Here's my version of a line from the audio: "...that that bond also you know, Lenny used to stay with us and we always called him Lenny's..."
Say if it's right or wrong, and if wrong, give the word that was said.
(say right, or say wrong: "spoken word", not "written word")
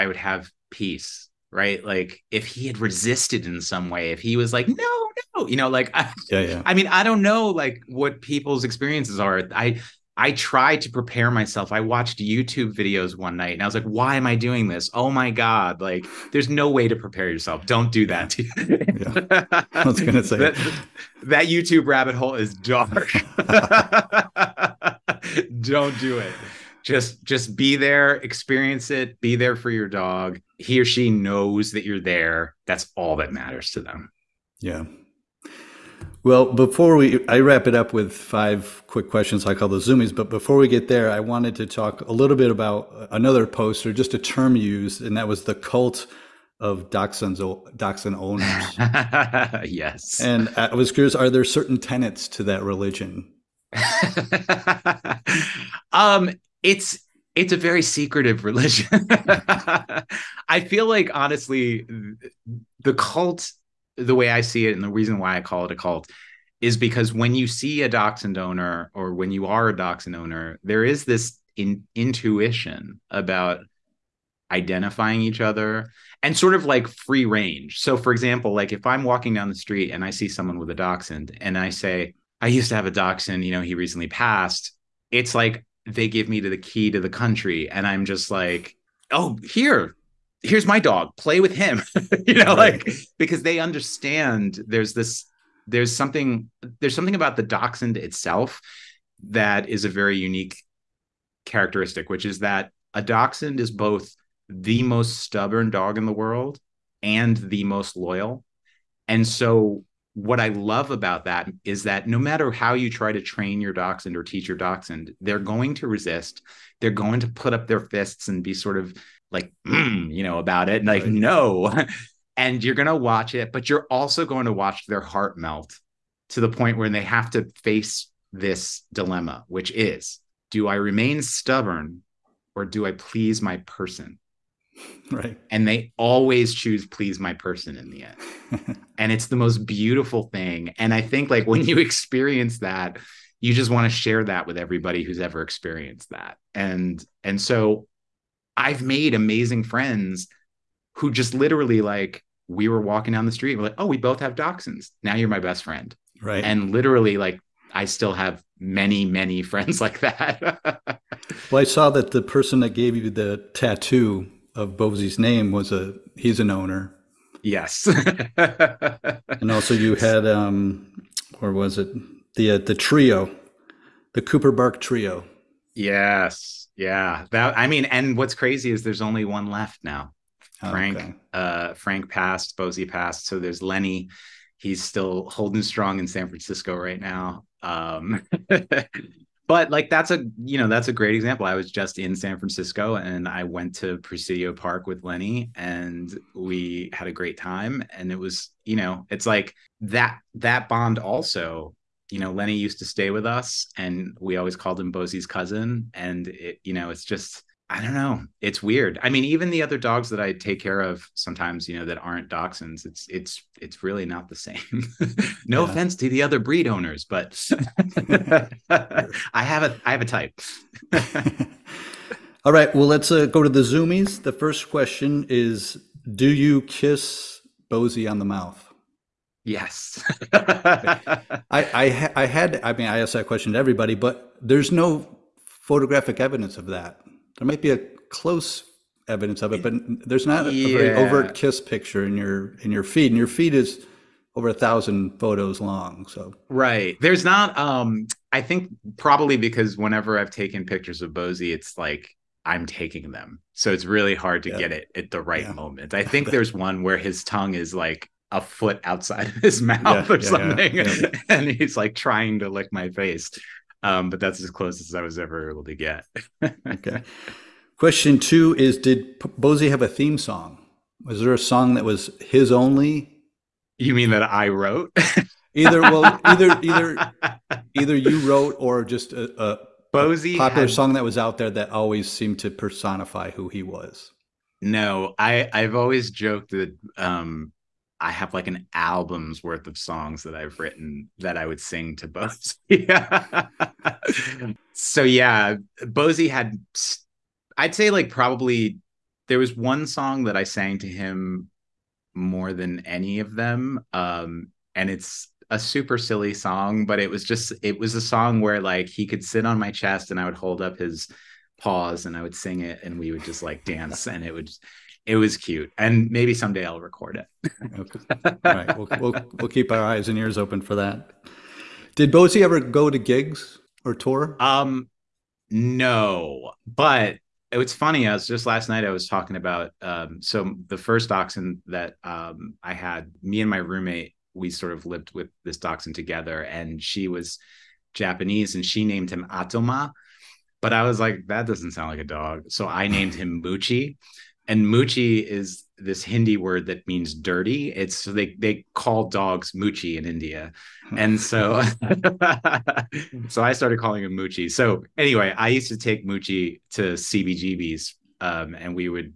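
wrong: "Bosie", not "Lenny".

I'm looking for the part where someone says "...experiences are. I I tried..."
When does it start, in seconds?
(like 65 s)
8 s.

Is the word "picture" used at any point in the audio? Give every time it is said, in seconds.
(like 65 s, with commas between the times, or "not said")
241 s, 250 s.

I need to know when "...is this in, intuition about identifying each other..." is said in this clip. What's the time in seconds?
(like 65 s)
70 s.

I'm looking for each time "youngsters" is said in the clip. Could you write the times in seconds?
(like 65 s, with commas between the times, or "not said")
not said.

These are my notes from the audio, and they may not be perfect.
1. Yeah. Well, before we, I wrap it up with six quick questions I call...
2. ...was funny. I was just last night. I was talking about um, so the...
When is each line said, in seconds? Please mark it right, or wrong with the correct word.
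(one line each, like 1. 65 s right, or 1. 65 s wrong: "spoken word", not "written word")
1. 34 s wrong: "five", not "six"
2. 327 s right.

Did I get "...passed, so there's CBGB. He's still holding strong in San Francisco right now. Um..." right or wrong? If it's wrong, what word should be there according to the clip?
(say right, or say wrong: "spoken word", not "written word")
wrong: "Lenny", not "CBGB".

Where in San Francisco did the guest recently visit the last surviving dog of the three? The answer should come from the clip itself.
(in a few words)
Presidio Park.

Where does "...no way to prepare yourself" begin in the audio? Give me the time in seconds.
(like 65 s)
16 s.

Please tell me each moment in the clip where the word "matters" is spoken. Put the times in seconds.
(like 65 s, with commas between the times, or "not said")
33 s, 112 s.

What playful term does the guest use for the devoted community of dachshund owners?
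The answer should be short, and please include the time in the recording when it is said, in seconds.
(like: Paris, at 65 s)
The cult of dachshunds, at 45 s.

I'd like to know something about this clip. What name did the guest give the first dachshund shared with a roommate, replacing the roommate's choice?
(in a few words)
Moochie.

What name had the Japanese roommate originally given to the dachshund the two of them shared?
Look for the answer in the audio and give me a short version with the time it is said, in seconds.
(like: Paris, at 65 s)
Atoma, at 339 s.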